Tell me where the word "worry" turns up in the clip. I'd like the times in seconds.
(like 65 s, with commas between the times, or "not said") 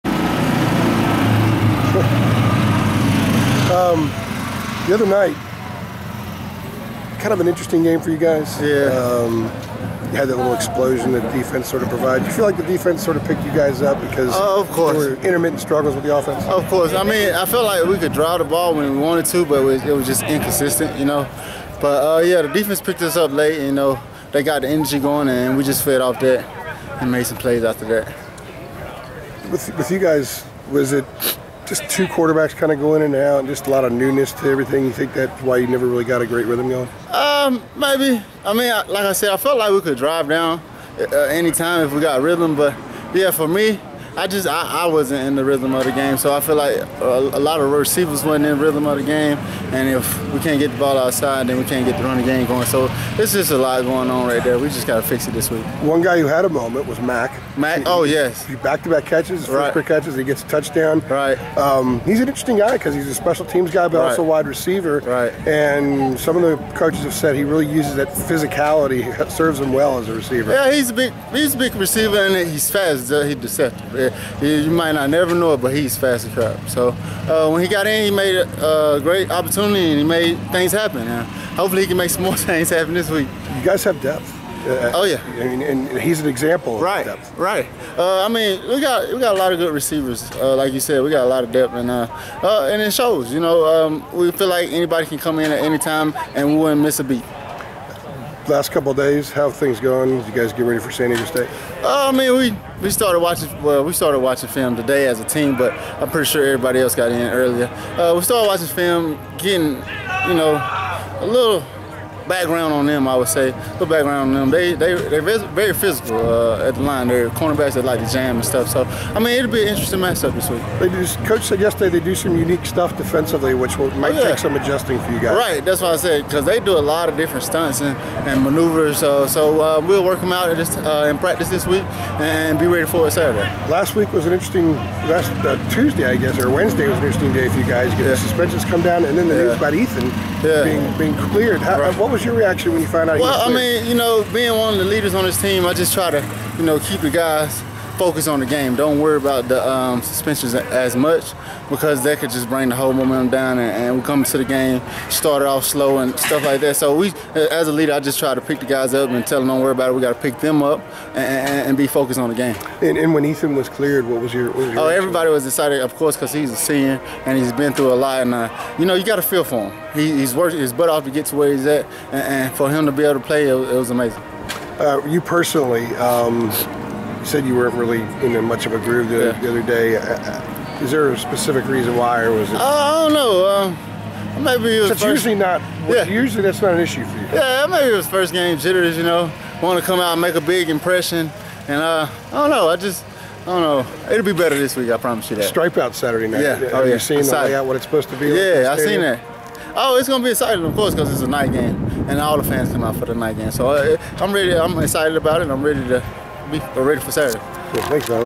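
148 s, 159 s.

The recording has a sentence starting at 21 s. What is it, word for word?
But uh, yeah, the defense picked us up late.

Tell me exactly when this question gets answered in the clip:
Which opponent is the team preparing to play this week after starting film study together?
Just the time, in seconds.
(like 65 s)
100 s.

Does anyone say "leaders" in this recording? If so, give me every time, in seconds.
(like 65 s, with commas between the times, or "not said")
144 s, 157 s.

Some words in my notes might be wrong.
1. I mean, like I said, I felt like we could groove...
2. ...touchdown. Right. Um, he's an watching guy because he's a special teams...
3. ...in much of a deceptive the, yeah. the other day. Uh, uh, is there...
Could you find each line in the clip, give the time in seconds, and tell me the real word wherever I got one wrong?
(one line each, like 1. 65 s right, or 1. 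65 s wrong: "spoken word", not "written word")
1. 38 s wrong: "drive", not "groove"
2. 60 s wrong: "interesting", not "watching"
3. 178 s wrong: "groove", not "deceptive".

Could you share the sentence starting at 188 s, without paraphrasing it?
You know, want to come out and make a big impression, and uh, I don't know.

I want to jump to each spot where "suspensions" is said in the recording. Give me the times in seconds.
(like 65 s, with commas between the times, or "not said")
138 s, 150 s.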